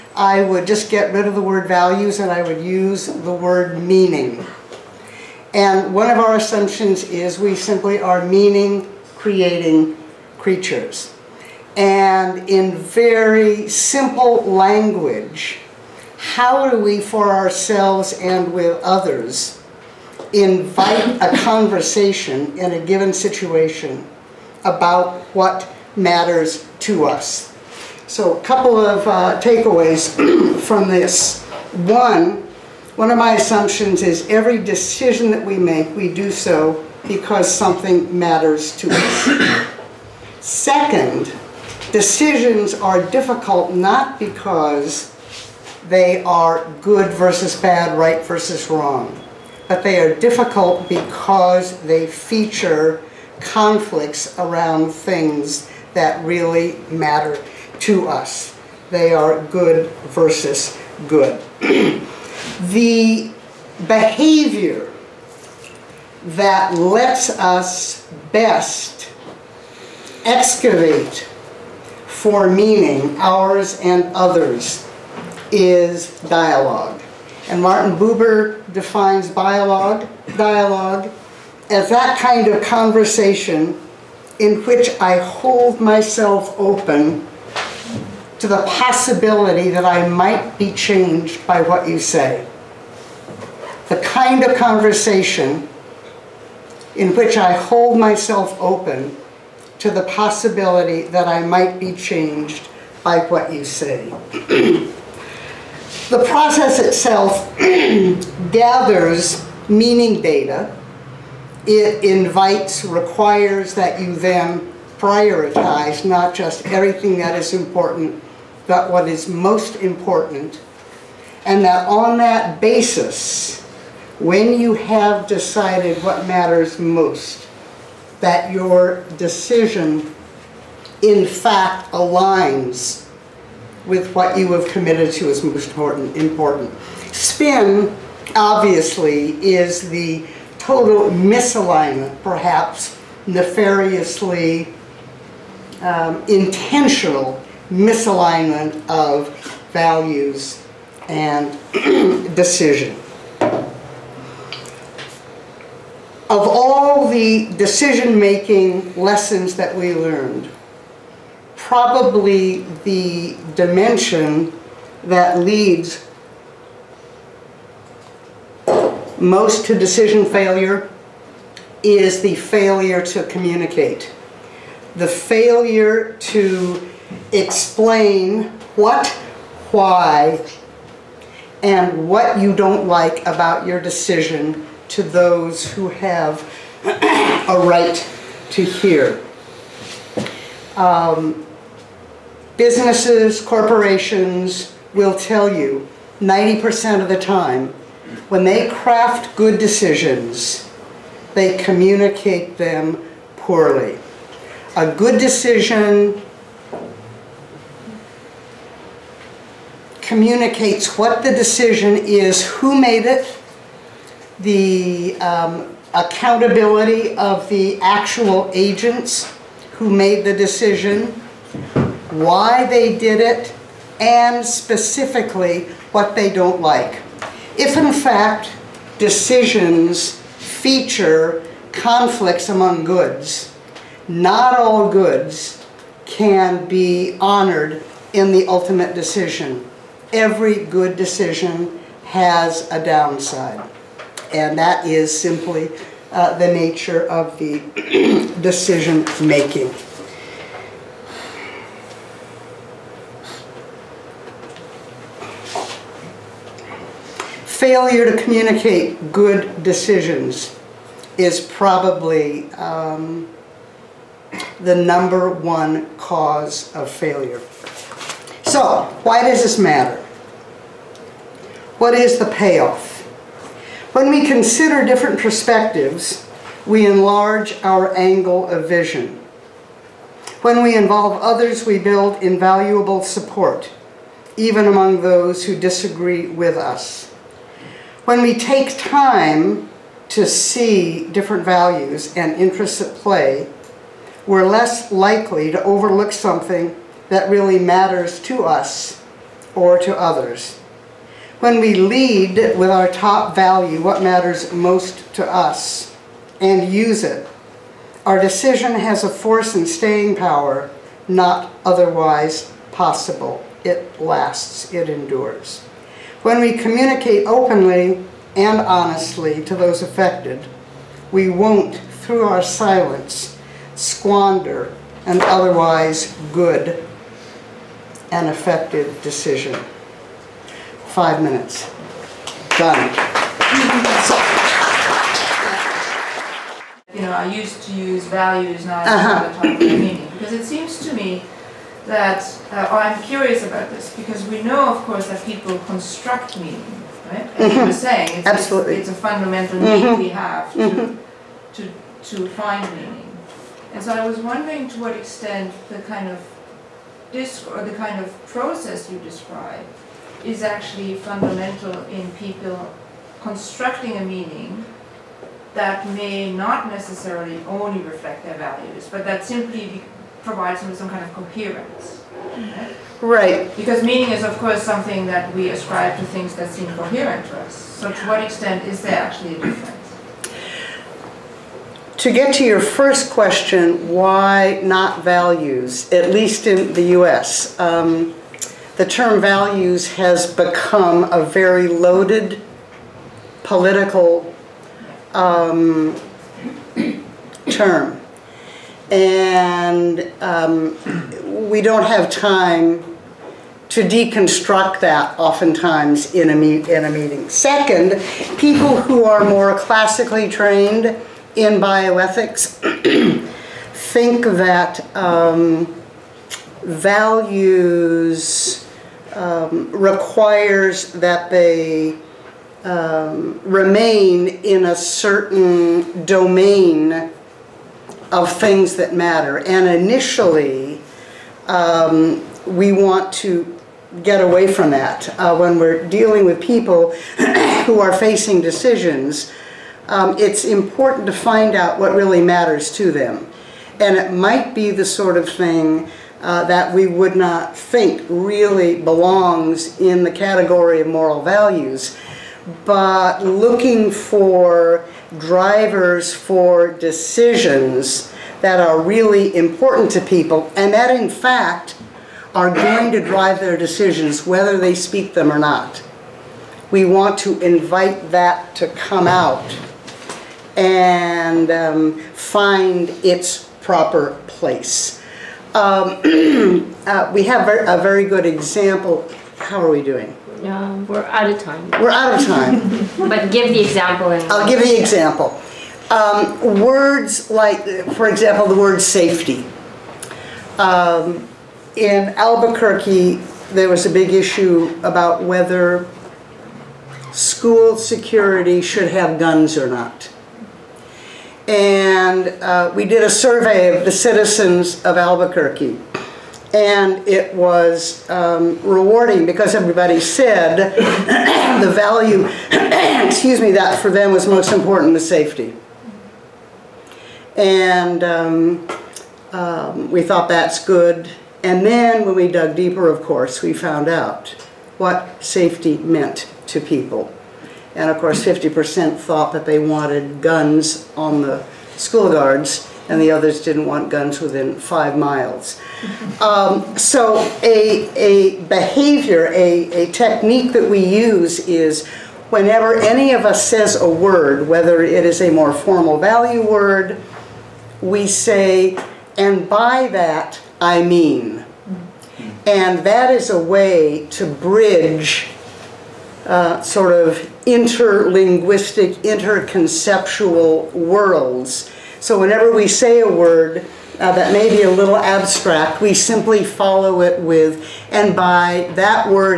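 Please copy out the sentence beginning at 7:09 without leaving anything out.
And initially, um, we want to get away from that.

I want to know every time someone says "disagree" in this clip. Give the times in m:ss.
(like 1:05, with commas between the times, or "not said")
4:45.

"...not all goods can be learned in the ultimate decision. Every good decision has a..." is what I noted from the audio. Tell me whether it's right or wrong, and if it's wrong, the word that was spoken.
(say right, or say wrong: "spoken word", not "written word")
wrong: "honored", not "learned".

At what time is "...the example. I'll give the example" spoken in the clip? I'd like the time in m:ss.
8:03.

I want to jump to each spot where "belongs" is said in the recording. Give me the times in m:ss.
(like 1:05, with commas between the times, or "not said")
7:28.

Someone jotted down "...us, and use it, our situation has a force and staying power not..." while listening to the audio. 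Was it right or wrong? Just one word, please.
wrong.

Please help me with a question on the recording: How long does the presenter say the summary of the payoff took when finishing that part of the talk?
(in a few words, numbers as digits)
Five minutes.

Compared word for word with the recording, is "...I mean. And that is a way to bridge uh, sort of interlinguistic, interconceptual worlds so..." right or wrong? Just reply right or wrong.
right.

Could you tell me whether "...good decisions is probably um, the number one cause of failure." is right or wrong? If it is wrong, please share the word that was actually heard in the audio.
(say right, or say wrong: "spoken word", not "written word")
right.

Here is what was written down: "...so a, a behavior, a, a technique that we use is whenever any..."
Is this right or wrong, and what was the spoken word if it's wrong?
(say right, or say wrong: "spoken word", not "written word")
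right.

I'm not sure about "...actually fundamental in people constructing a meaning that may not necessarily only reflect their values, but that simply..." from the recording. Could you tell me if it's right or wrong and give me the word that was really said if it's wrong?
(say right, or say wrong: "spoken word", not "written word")
right.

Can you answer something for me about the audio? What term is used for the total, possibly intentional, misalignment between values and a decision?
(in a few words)
Spin.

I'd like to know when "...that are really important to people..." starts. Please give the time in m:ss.
7:38.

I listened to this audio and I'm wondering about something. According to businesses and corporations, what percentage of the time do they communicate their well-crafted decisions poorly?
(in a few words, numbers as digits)
90%.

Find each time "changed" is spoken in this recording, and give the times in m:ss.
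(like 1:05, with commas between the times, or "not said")
1:30, 1:41.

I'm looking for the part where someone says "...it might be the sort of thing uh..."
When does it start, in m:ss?
7:23.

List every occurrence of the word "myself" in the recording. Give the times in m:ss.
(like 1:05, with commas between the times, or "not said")
1:25, 1:37.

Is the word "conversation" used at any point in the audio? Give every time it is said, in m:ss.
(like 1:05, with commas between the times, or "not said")
0:21, 1:22, 1:34.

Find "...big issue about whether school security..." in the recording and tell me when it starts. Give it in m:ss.
8:13.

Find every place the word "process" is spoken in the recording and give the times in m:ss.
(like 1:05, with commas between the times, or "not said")
1:46, 5:58.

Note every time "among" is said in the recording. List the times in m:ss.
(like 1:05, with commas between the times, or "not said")
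3:52, 4:44.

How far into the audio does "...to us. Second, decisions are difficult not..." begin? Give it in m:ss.
0:38.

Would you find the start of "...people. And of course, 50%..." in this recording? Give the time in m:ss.
8:46.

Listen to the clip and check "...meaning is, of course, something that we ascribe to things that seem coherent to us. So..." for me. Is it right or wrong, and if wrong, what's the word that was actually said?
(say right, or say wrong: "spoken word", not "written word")
right.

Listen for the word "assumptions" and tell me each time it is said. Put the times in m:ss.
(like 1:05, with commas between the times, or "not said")
0:06, 0:33.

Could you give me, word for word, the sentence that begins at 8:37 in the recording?
And um, um, we thought that's good.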